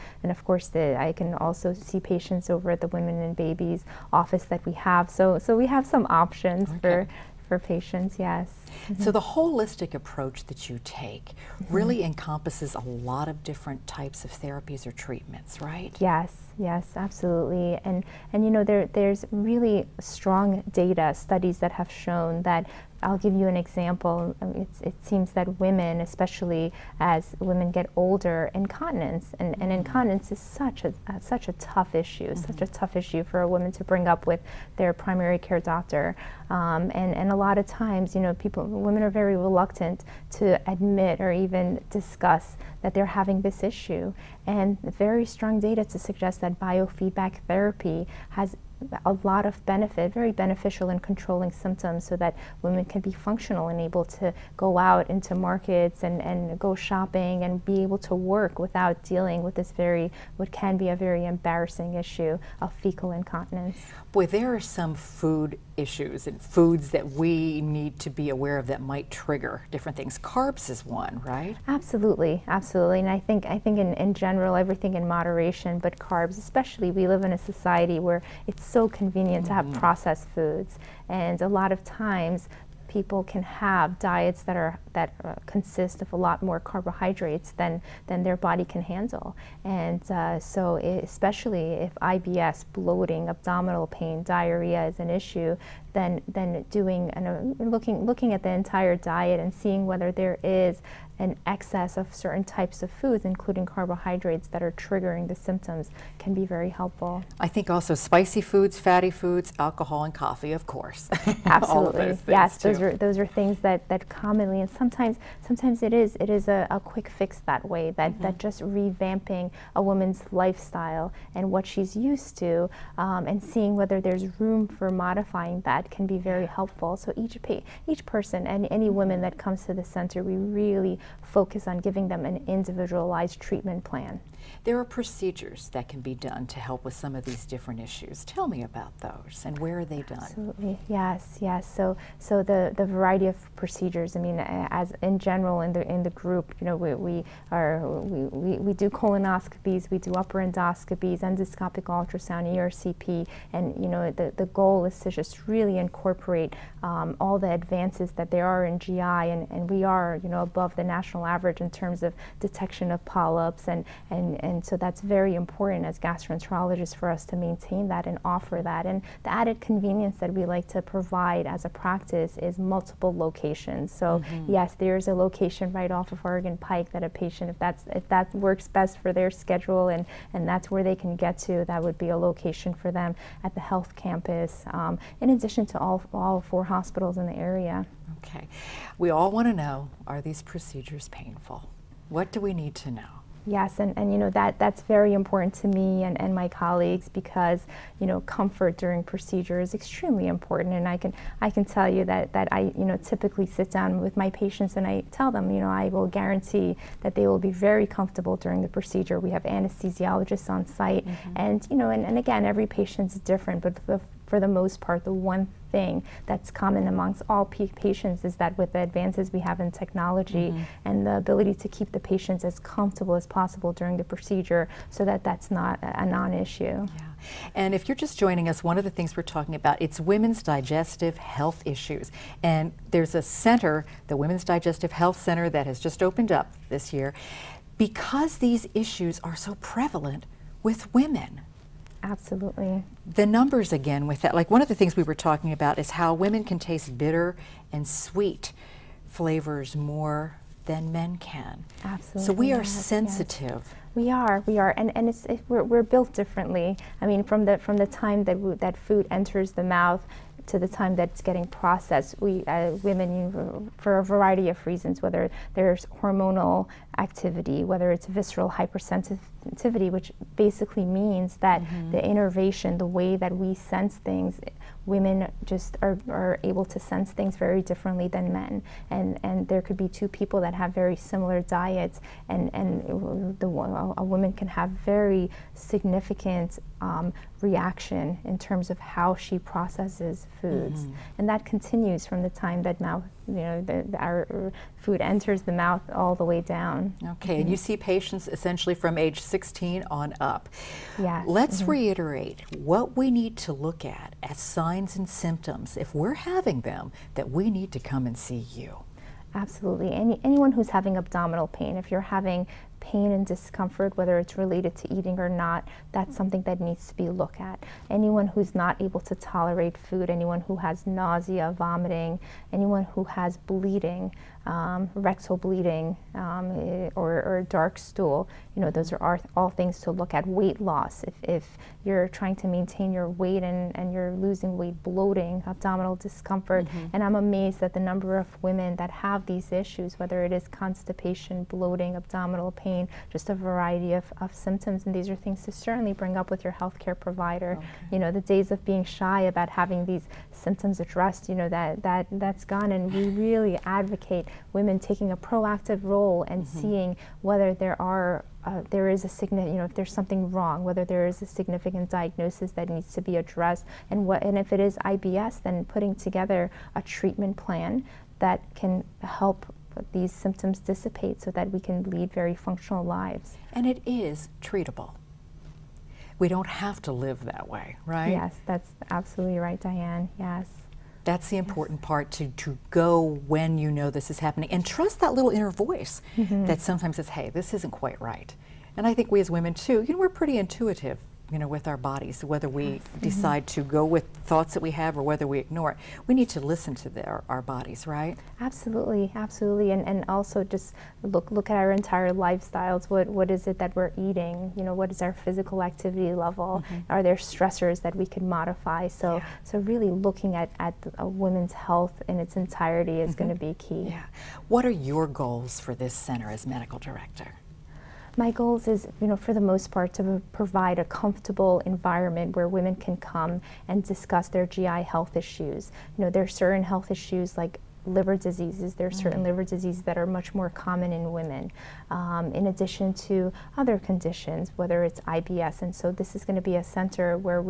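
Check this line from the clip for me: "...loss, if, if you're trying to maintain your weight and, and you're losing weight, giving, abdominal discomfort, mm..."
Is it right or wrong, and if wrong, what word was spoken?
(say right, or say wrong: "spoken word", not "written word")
wrong: "bloating", not "giving".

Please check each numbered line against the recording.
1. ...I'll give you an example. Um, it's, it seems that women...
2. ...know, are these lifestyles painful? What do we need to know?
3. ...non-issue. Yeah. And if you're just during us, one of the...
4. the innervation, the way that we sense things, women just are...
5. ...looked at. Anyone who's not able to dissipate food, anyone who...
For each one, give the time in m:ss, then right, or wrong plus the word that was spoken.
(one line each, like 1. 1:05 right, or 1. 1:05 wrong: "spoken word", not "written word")
1. 0:23 right
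2. 3:09 wrong: "procedures", not "lifestyles"
3. 3:46 wrong: "joining", not "during"
4. 4:31 right
5. 5:17 wrong: "tolerate", not "dissipate".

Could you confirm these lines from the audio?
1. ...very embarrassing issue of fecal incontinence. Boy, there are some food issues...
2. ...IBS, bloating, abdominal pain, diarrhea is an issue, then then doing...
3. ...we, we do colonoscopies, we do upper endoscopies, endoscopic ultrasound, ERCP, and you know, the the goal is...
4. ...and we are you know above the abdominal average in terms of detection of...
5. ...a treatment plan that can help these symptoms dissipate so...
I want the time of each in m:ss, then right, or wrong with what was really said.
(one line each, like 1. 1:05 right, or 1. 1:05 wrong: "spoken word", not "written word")
1. 1:00 right
2. 1:32 right
3. 2:28 right
4. 2:39 wrong: "national", not "abdominal"
5. 6:06 right.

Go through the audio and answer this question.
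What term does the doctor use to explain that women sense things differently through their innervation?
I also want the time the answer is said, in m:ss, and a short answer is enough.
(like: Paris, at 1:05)
visceral hypersensitivity, at 4:28.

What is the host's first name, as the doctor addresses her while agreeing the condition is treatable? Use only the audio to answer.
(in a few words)
Diane.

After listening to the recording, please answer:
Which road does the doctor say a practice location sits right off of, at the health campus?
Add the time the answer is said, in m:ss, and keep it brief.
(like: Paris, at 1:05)
Oregon Pike, at 2:56.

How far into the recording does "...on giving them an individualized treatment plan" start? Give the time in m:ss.
2:11.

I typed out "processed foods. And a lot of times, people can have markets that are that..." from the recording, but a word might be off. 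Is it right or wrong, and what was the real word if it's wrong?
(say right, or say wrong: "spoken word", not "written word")
wrong: "diets", not "markets".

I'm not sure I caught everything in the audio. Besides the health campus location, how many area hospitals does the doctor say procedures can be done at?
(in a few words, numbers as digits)
4.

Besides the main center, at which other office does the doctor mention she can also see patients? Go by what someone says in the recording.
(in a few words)
Women and Babies office.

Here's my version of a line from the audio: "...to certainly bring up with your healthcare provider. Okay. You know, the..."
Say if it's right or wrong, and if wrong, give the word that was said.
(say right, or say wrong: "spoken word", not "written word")
right.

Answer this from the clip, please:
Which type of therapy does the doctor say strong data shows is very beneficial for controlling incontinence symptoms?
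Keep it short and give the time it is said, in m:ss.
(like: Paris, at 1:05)
biofeedback therapy, at 0:46.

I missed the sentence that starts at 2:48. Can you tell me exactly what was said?
And the added convenience that we like to provide as a practice is multiple locations.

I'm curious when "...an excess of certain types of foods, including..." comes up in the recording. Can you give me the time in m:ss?
1:41.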